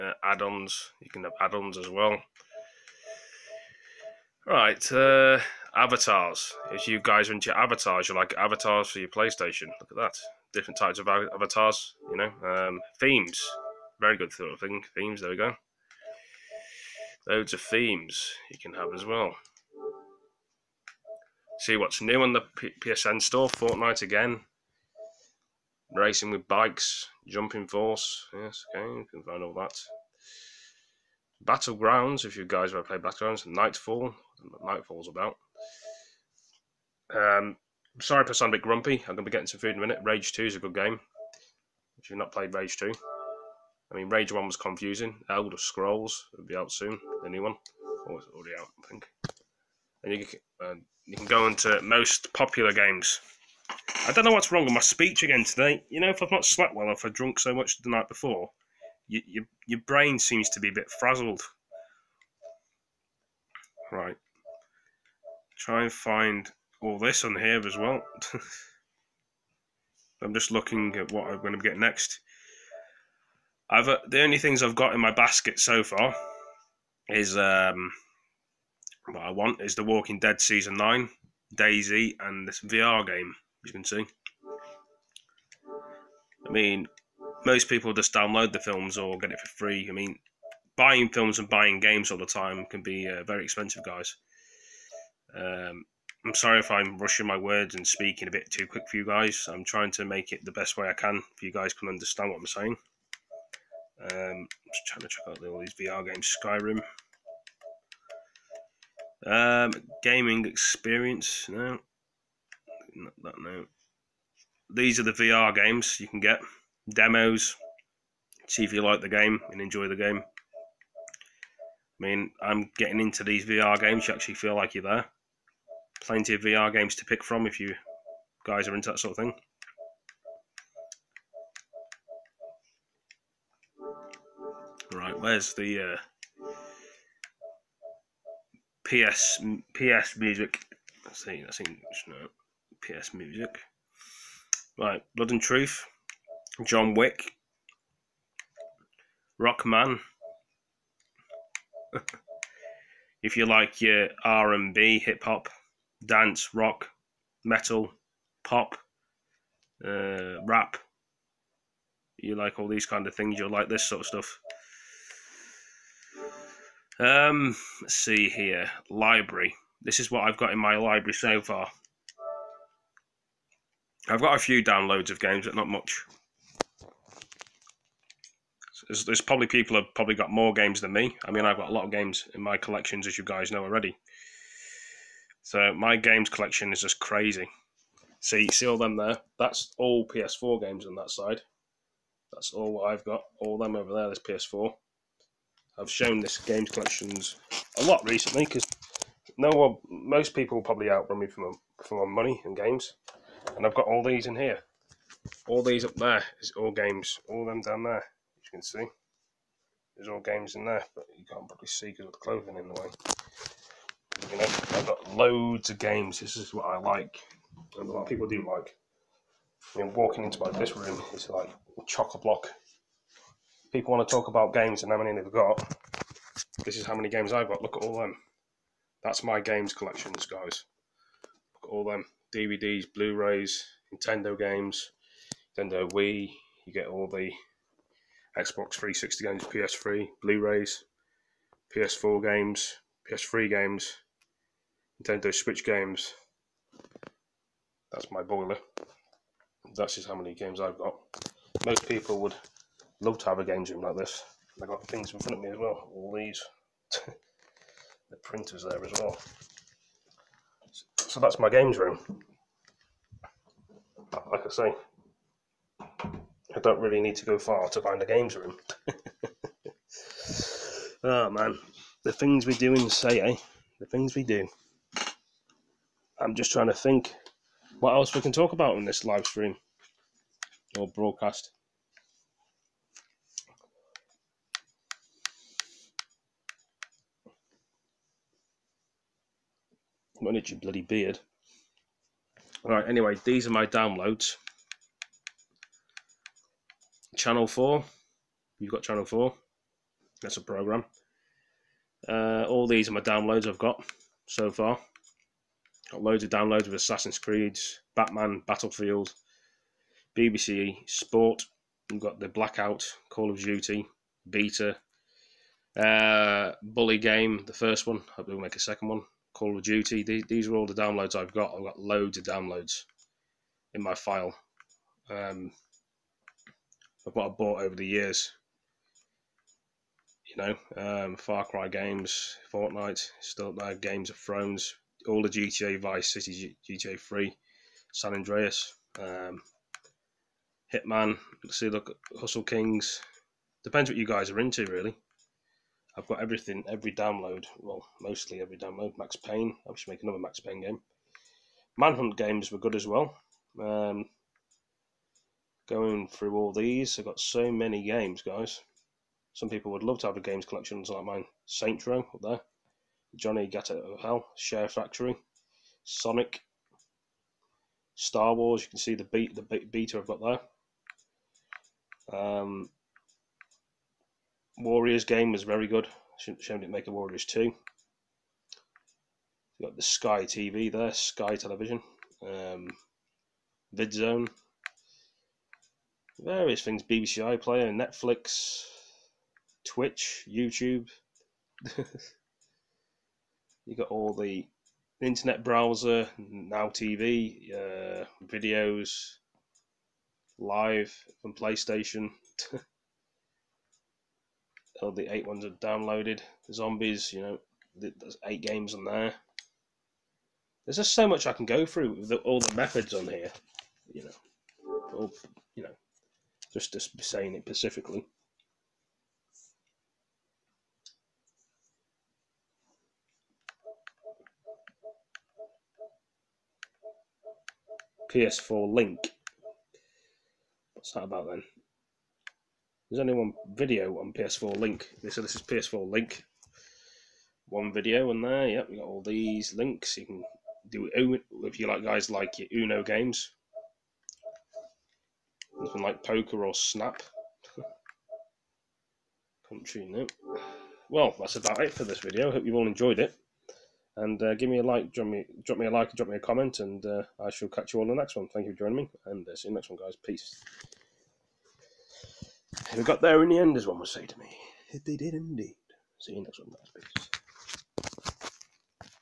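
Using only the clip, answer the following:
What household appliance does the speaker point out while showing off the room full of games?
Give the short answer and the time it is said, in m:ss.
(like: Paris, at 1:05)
Boiler, at 4:07.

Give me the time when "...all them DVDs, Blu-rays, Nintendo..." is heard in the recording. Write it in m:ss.
3:51.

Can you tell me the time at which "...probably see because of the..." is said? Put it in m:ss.
3:31.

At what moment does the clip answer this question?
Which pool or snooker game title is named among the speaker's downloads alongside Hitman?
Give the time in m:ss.
5:42.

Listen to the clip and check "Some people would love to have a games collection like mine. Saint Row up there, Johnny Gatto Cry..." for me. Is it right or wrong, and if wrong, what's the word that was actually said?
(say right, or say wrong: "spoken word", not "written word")
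wrong: "Hell", not "Cry".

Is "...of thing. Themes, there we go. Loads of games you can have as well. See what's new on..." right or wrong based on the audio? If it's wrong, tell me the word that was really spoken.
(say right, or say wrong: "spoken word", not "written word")
wrong: "themes", not "games".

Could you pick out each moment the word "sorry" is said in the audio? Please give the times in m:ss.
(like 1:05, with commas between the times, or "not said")
0:37, 1:36.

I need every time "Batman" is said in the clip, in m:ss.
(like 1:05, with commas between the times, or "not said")
5:07.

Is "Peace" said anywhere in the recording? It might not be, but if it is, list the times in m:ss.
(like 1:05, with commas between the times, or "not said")
7:40, 7:47.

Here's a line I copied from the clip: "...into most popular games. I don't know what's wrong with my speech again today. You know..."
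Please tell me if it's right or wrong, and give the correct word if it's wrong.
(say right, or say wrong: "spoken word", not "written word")
right.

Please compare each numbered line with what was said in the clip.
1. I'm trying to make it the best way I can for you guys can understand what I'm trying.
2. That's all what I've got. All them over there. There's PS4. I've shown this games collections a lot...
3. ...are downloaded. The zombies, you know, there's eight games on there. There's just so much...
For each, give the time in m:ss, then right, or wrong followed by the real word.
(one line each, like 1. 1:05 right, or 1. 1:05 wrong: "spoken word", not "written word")
1. 1:39 wrong: "saying", not "trying"
2. 3:12 right
3. 6:45 right.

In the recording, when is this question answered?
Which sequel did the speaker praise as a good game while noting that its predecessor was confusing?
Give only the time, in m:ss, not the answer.
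0:40.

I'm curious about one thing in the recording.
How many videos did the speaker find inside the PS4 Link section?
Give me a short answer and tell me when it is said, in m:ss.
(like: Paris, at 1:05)
1, at 7:12.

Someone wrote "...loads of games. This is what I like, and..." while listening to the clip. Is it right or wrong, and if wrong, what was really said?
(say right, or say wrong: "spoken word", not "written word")
right.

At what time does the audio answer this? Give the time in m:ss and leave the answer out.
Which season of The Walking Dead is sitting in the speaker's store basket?
1:20.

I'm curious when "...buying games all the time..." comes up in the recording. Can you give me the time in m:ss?
1:31.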